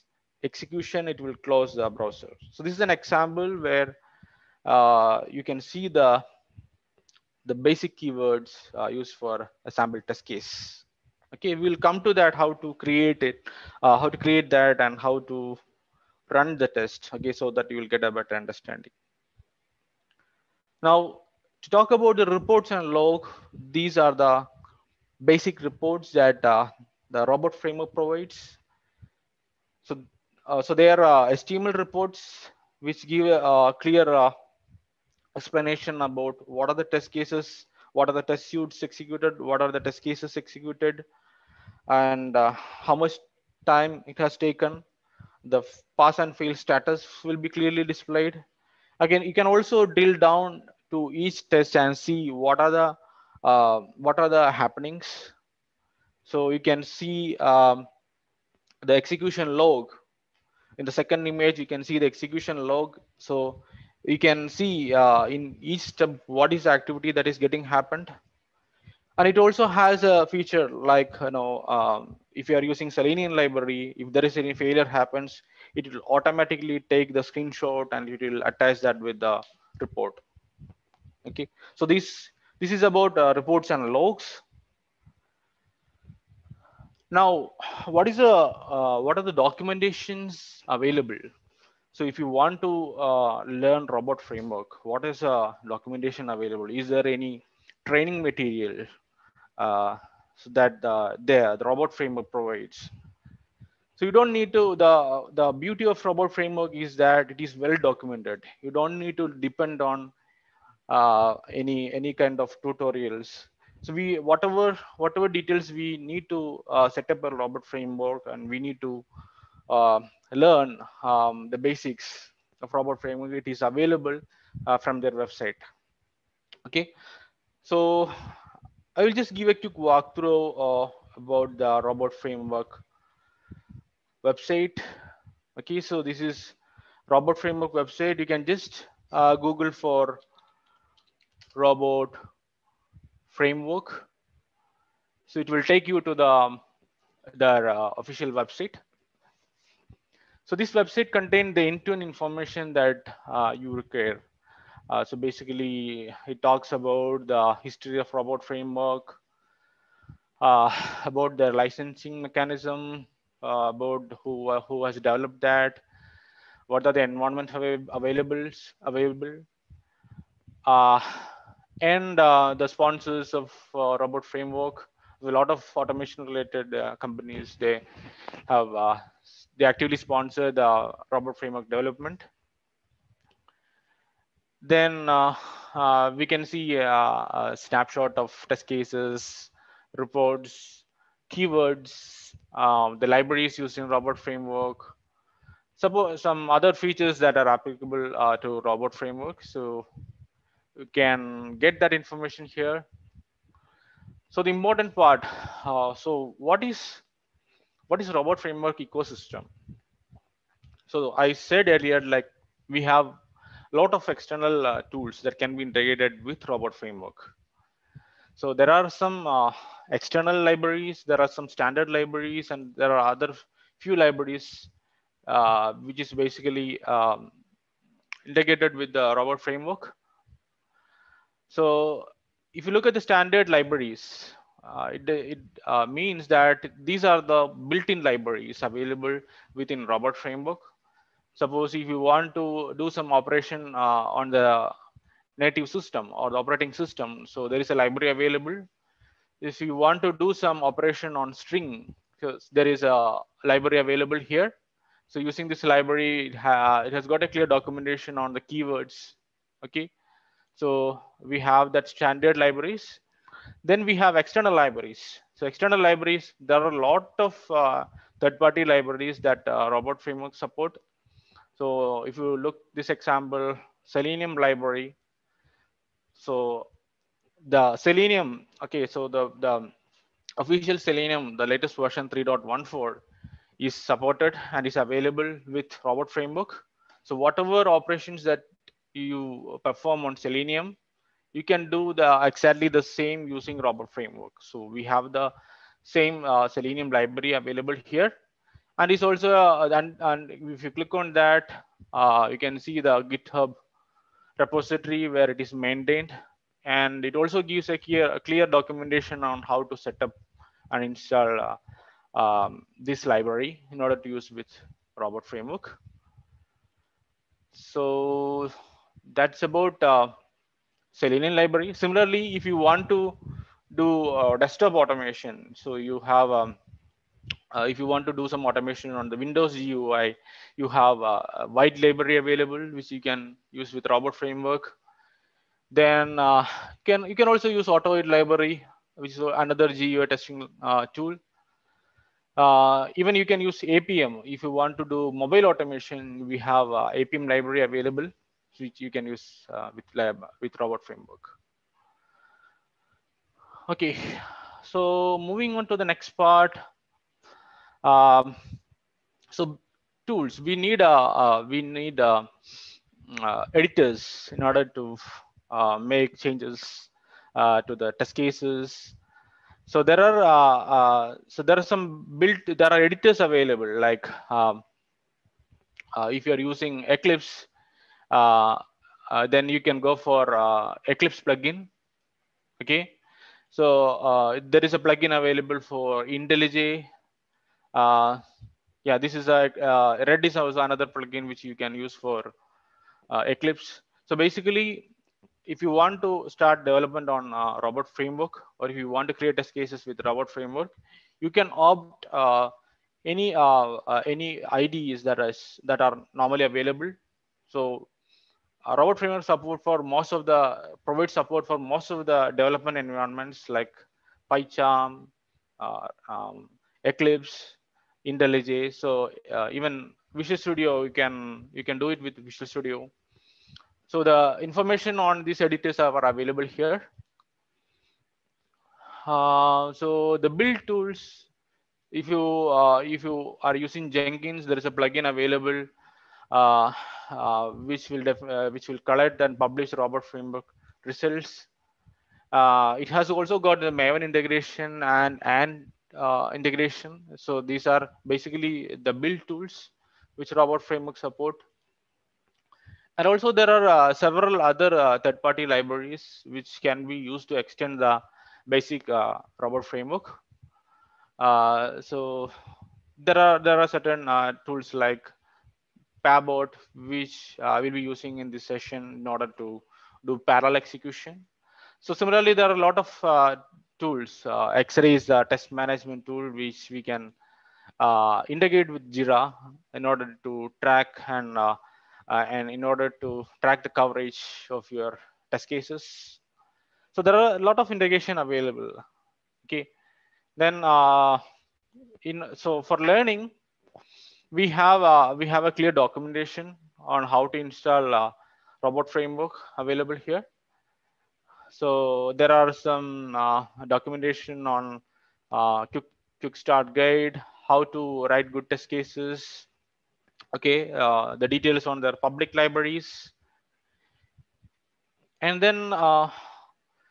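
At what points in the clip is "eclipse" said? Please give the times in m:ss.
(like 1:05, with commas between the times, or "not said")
6:16, 6:20, 6:33, 6:56.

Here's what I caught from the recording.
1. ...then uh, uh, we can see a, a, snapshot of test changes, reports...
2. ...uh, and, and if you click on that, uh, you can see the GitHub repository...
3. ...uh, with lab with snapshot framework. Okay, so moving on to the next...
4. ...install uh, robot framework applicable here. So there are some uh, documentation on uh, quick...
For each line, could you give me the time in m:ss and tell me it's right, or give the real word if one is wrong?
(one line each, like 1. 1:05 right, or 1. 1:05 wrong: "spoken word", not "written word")
1. 3:04 wrong: "cases", not "changes"
2. 4:59 right
3. 5:49 wrong: "robot", not "snapshot"
4. 8:17 wrong: "available", not "applicable".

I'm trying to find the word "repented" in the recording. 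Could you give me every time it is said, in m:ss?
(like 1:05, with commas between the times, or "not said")
not said.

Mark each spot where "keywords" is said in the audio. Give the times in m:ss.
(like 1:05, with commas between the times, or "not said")
0:07, 3:11, 4:18.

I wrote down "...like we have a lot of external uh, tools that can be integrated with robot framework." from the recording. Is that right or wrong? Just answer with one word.
right.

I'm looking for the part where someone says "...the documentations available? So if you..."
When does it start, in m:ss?
1:29.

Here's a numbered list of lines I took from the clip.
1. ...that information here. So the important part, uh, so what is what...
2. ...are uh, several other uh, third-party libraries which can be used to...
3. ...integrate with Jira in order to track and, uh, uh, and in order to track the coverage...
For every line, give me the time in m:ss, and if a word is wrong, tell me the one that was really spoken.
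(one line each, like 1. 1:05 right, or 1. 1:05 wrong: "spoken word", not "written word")
1. 3:21 right
2. 7:33 right
3. 7:58 right.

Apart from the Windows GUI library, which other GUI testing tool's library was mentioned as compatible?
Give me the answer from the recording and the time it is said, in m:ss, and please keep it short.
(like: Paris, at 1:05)
AutoIt, at 5:37.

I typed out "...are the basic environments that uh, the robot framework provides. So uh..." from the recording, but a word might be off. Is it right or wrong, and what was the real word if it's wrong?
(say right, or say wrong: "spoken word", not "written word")
wrong: "reports", not "environments".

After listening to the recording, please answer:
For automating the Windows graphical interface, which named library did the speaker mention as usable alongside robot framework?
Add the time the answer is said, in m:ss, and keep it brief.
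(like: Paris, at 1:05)
White library, at 5:31.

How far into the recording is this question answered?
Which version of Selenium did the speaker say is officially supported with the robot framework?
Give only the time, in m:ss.
4:42.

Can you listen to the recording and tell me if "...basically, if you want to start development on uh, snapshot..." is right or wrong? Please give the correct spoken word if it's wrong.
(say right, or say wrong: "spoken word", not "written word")
wrong: "robot", not "snapshot".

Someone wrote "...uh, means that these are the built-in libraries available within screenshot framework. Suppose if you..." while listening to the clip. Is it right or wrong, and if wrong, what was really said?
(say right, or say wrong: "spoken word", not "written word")
wrong: "robot", not "screenshot".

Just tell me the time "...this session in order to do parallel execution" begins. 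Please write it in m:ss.
7:48.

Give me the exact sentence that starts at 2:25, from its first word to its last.
So it will take you to the, their uh, official website.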